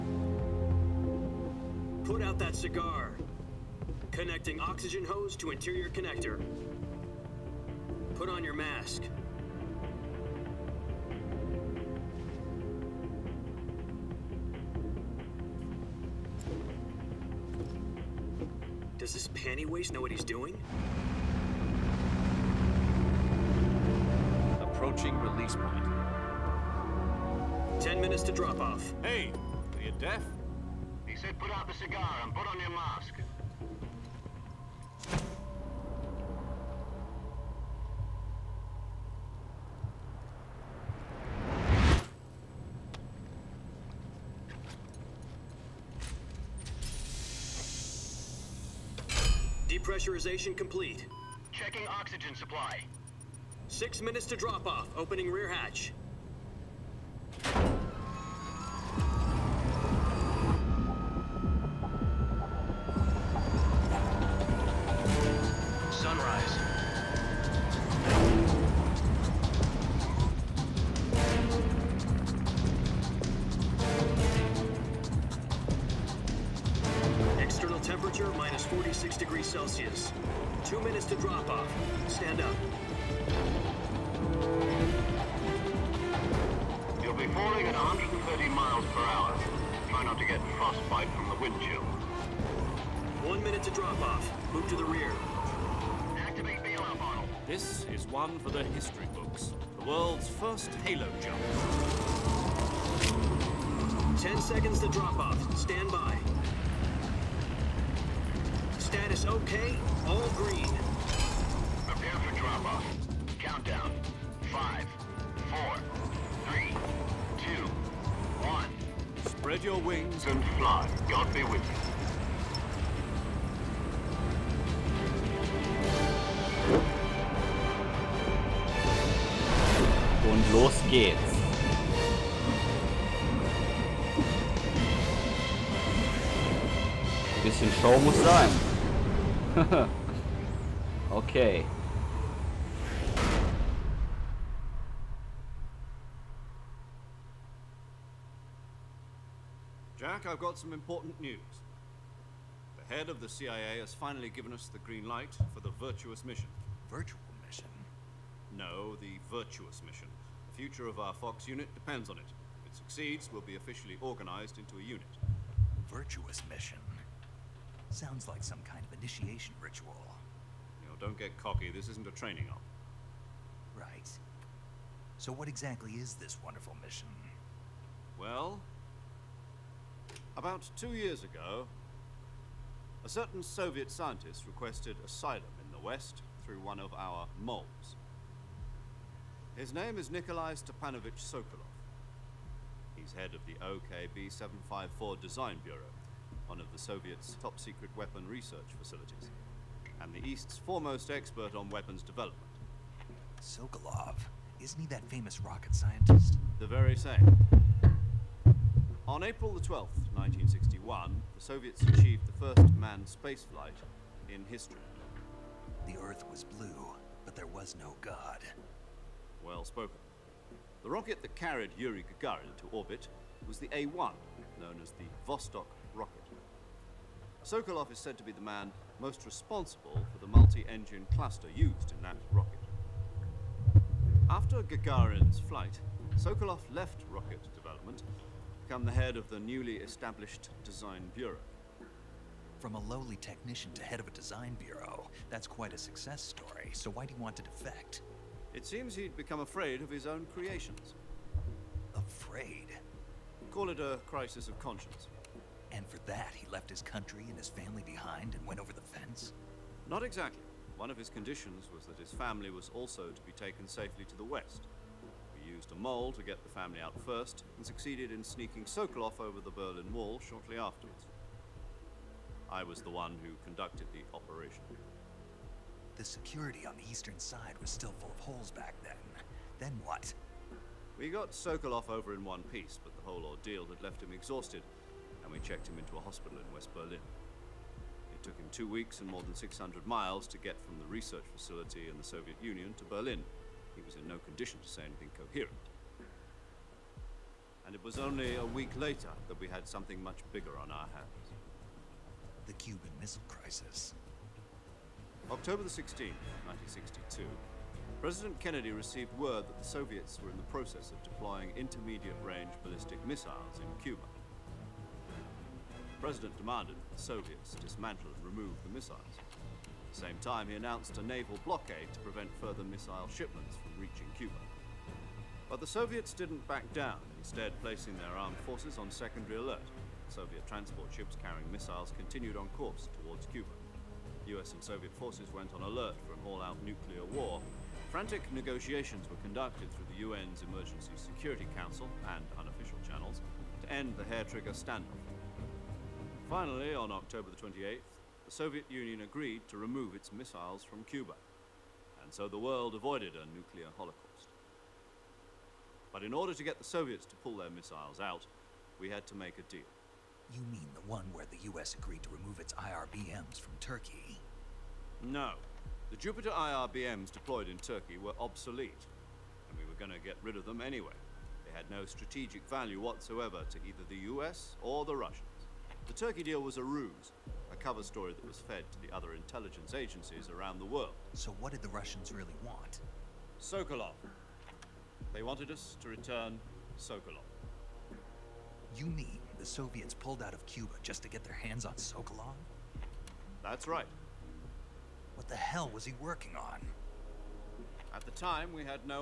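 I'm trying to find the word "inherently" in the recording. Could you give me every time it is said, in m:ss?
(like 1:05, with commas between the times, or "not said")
not said.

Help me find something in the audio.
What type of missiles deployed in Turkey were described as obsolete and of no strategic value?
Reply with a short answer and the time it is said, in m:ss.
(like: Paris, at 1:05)
Jupiter IRBMs, at 6:05.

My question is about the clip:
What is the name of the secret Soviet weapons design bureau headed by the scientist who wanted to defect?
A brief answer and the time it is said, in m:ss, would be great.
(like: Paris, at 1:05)
OKB754, at 3:13.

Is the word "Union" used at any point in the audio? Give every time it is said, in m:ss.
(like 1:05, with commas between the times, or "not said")
4:52, 5:48.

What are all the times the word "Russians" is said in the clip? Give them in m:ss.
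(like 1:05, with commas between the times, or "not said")
6:14, 6:21.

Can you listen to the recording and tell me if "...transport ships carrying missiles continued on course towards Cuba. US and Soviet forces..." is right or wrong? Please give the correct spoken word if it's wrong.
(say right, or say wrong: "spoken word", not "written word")
right.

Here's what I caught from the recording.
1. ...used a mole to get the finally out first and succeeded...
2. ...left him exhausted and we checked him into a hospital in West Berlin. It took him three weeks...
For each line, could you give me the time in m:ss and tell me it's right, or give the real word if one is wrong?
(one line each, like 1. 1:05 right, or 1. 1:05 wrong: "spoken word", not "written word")
1. 4:25 wrong: "family", not "finally"
2. 4:43 wrong: "two", not "three".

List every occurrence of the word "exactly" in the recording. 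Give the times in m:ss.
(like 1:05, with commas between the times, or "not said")
2:55, 4:20.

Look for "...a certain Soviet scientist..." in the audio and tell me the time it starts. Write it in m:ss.
3:03.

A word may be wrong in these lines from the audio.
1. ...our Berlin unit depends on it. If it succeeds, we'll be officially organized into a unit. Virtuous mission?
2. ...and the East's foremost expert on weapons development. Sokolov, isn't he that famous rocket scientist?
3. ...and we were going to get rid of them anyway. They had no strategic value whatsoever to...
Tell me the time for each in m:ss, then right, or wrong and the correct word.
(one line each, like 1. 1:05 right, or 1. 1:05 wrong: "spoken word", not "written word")
1. 2:40 wrong: "Fox", not "Berlin"
2. 3:20 right
3. 6:09 right.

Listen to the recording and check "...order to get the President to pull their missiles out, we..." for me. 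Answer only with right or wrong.
wrong.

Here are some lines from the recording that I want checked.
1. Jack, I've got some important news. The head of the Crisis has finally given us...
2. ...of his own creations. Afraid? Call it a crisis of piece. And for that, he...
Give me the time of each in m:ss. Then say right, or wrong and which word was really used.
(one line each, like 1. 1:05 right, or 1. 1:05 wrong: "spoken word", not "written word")
1. 2:29 wrong: "CIA", not "Crisis"
2. 4:09 wrong: "conscience", not "piece".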